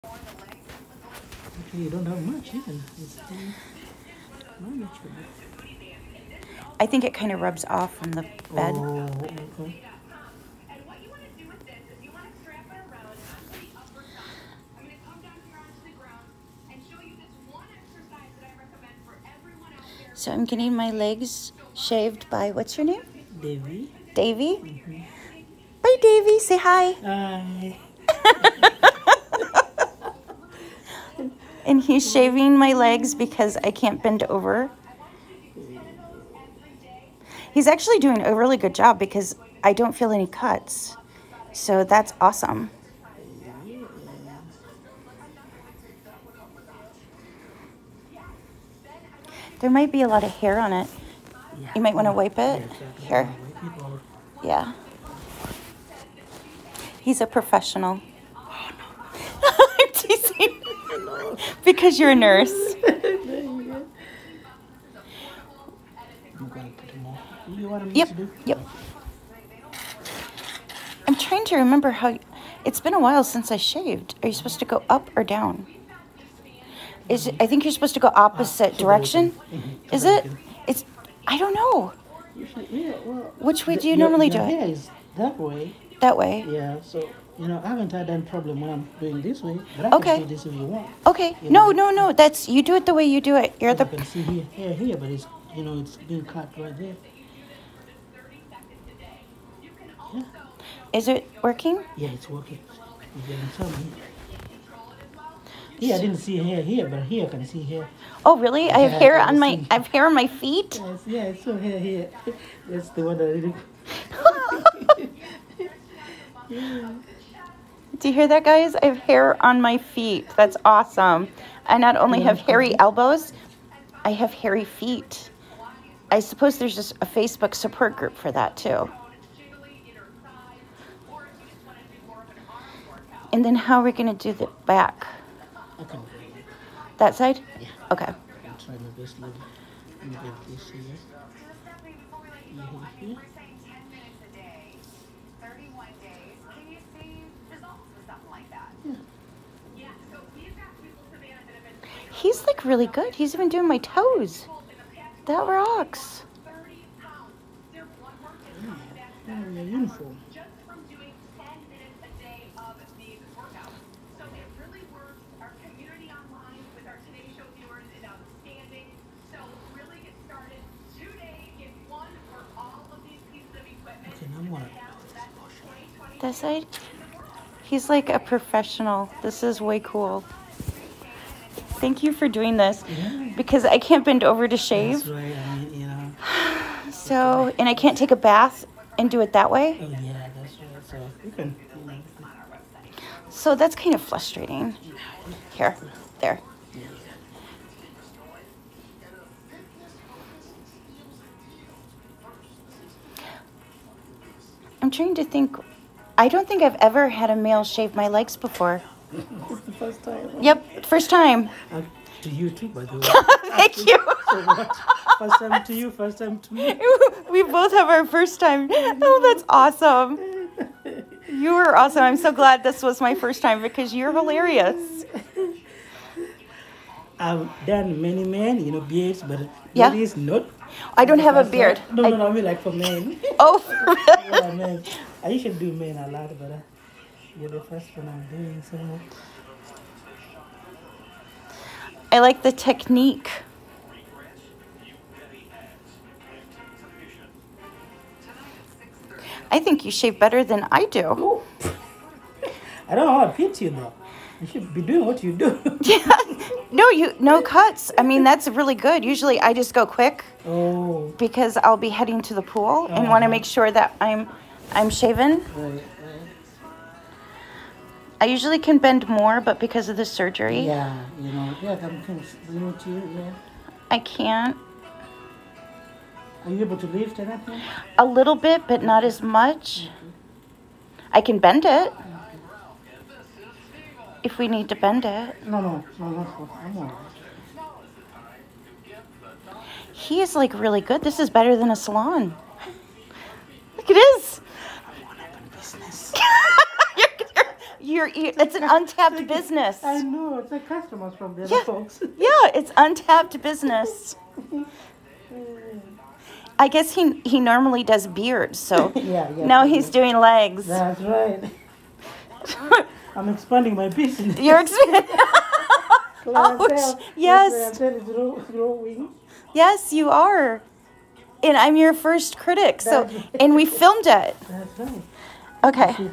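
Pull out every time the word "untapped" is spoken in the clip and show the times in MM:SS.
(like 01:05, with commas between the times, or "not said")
04:58, 05:02.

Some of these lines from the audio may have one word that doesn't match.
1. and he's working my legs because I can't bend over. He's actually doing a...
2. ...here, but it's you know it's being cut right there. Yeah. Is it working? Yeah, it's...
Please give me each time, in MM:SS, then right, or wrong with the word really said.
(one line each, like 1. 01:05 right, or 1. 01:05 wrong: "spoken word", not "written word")
1. 00:31 wrong: "shaving", not "working"
2. 01:34 right.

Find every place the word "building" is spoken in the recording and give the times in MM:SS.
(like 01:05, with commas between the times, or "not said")
not said.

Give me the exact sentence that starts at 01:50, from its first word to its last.
Yes, yeah, it's so hair here.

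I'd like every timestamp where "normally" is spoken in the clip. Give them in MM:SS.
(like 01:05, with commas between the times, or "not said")
01:23, 05:07.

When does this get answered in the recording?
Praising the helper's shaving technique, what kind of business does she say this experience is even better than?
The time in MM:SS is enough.
04:51.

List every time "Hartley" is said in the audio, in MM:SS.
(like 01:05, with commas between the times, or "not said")
not said.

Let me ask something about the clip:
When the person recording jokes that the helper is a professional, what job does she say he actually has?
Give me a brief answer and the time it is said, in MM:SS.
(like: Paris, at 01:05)
nurse, at 01:02.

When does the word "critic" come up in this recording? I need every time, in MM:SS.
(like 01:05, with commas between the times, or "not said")
05:22.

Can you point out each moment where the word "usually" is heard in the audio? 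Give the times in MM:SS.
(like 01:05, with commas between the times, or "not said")
04:19, 04:28.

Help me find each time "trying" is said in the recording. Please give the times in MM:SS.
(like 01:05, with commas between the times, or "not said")
01:11, 02:18, 03:24.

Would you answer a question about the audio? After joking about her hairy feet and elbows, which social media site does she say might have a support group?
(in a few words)
Facebook.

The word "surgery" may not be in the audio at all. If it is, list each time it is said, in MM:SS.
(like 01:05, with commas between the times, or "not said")
04:30.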